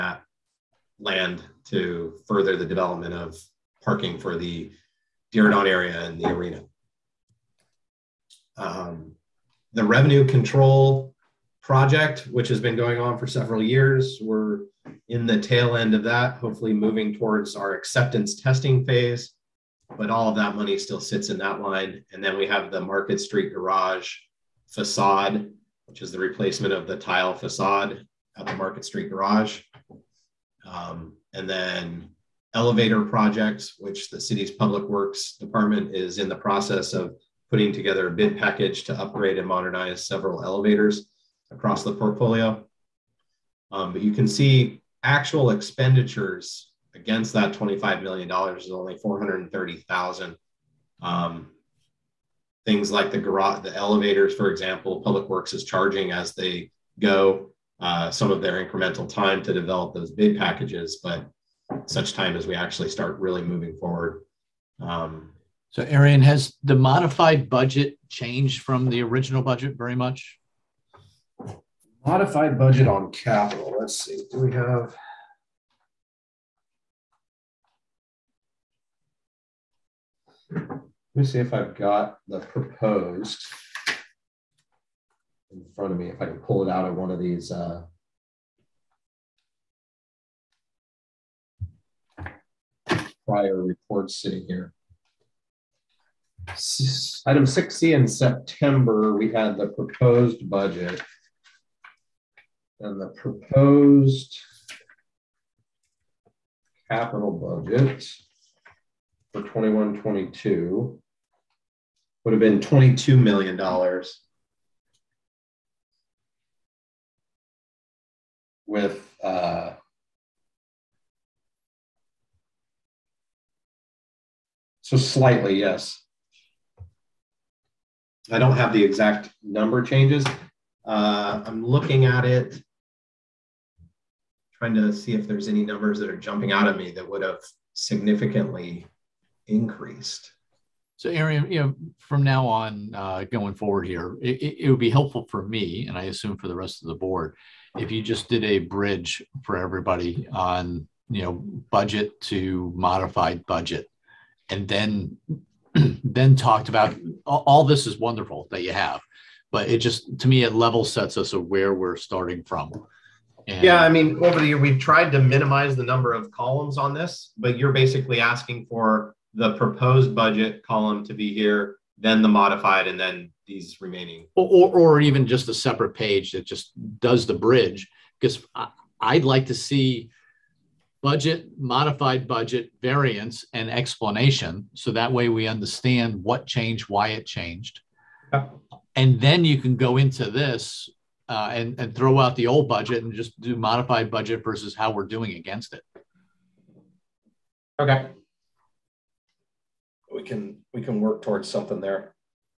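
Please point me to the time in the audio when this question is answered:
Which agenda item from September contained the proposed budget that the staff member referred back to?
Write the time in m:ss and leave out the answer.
1:37.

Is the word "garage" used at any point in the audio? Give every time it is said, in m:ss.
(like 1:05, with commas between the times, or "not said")
0:23, 0:29, 0:53.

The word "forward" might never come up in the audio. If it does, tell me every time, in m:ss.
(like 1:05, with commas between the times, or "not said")
1:03, 2:23.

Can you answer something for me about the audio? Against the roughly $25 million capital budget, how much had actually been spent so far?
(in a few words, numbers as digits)
$430,000.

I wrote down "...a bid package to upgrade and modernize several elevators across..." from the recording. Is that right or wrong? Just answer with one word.
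right.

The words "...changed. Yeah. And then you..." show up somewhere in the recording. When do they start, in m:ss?
3:07.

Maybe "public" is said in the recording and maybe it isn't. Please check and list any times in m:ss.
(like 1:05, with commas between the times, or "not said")
0:34, 0:55.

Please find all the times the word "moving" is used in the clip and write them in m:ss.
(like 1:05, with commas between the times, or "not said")
0:16, 1:03.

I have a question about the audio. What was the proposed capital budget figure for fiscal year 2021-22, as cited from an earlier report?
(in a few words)
$22 million.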